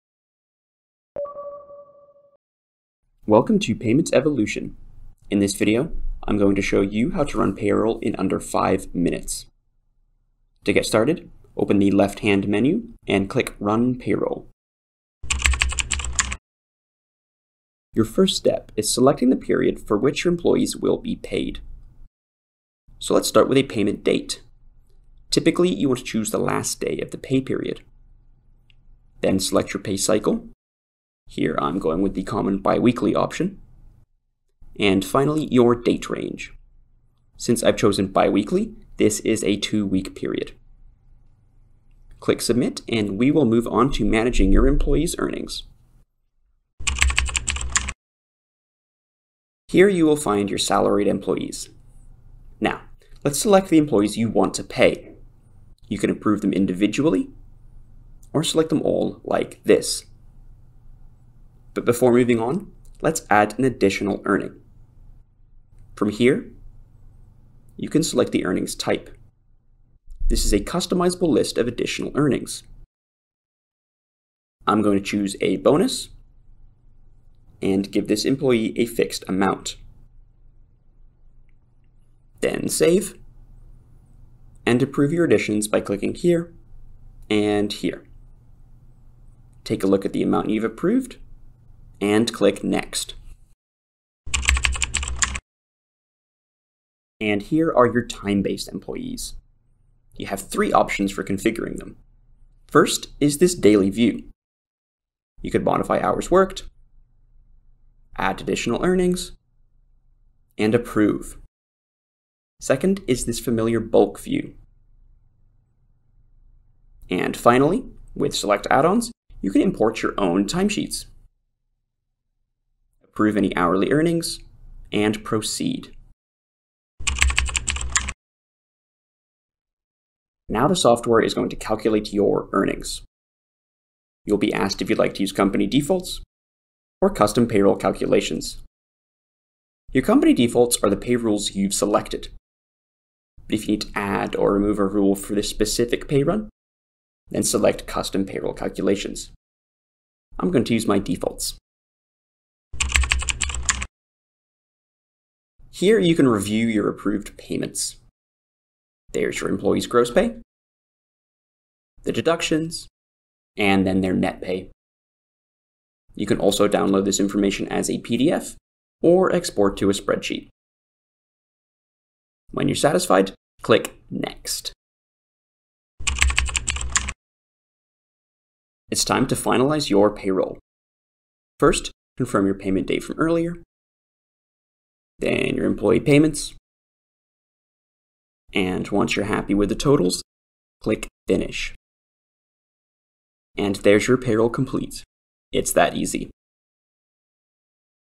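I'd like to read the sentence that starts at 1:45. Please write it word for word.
You could modify hours worked, add additional earnings, and approve.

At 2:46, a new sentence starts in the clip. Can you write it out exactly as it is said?
You can also download this information as a PDF or export to a spreadsheet.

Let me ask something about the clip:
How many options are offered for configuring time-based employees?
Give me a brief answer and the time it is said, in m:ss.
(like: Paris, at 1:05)
3, at 1:40.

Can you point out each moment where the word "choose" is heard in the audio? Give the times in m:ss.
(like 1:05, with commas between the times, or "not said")
0:26, 1:15.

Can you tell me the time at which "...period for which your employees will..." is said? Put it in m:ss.
0:19.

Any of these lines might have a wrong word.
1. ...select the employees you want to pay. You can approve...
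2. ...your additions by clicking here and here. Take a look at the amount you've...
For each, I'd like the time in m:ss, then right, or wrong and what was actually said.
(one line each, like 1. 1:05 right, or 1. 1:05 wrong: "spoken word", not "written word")
1. 0:53 right
2. 1:25 right.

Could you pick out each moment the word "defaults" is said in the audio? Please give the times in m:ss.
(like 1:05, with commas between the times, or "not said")
2:15, 2:20, 2:30.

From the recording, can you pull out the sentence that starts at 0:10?
To get started, open the left-hand menu and click Run Payroll.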